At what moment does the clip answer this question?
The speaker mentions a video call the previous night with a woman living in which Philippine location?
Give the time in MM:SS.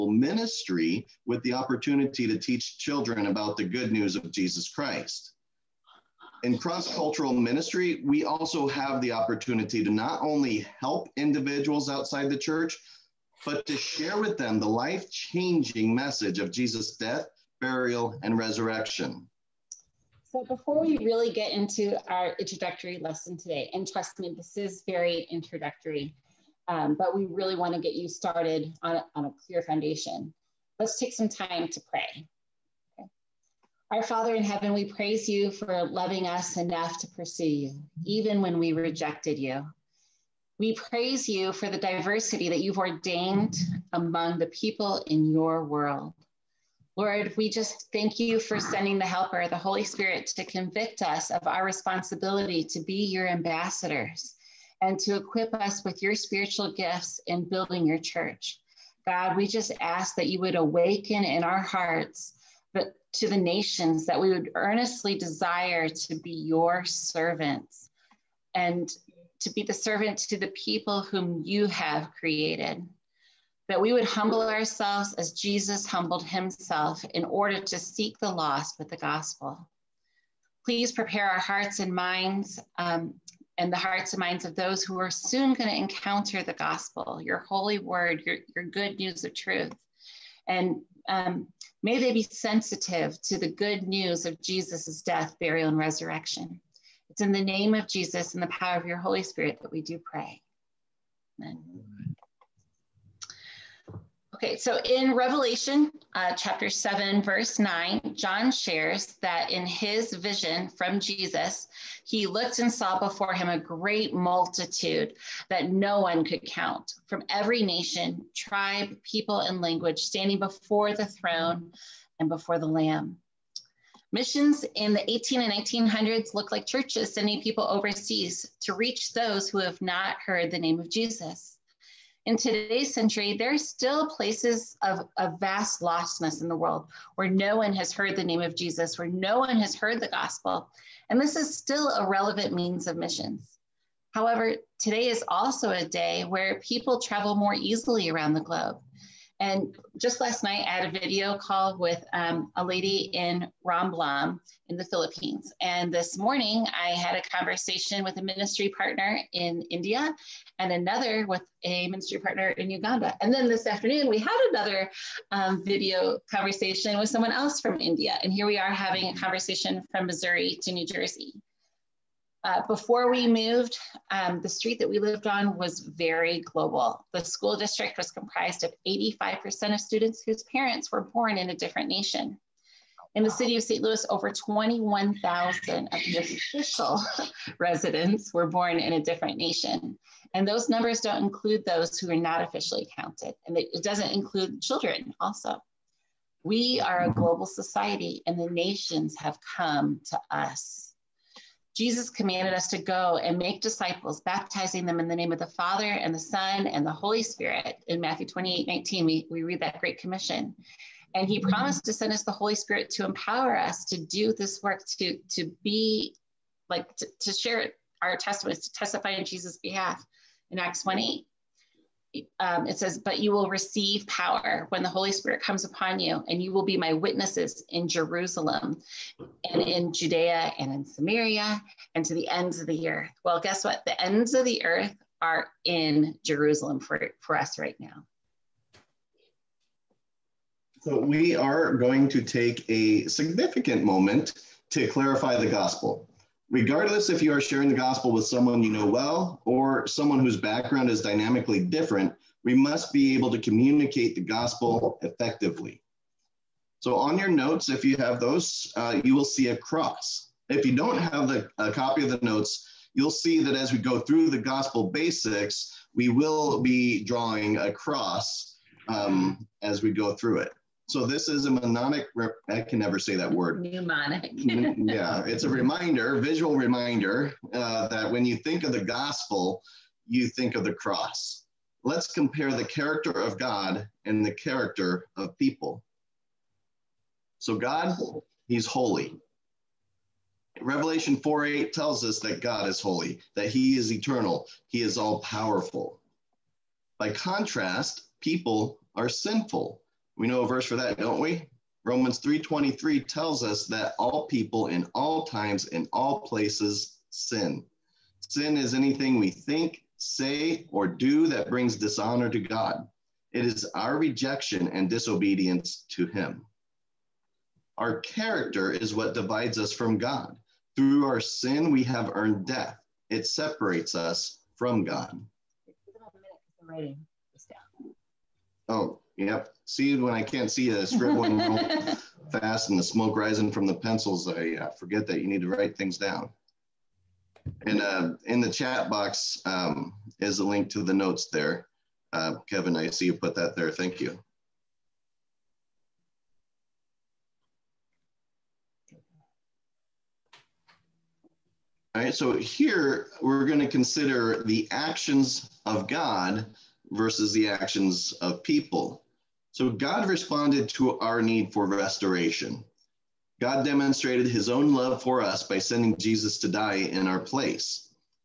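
02:33.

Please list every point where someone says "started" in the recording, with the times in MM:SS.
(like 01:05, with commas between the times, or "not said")
00:28.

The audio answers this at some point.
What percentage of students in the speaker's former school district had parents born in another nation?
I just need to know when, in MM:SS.
02:58.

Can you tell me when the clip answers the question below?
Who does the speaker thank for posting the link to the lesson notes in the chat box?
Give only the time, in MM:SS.
05:42.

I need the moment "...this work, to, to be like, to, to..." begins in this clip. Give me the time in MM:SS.
03:34.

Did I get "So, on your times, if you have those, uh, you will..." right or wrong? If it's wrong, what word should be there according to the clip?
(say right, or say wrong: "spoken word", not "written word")
wrong: "notes", not "times".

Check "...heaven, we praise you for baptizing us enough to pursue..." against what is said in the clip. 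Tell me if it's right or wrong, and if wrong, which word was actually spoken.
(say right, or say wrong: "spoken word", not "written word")
wrong: "loving", not "baptizing".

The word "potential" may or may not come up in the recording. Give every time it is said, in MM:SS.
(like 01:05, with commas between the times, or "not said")
not said.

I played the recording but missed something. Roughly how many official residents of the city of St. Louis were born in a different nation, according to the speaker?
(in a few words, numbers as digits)
21,000.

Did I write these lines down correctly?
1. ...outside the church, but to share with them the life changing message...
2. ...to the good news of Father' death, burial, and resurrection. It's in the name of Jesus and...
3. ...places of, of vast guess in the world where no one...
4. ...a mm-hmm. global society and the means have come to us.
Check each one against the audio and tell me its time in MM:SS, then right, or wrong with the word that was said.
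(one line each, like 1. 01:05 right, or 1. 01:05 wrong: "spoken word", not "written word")
1. 00:11 right
2. 01:33 wrong: "Jesus", not "Father"
3. 02:14 wrong: "lostness", not "guess"
4. 03:17 wrong: "nations", not "means".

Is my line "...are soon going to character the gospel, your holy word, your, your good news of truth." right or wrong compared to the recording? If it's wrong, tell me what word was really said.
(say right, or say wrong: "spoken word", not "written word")
wrong: "encounter", not "character".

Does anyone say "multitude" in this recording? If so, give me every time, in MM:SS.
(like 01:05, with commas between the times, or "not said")
01:54.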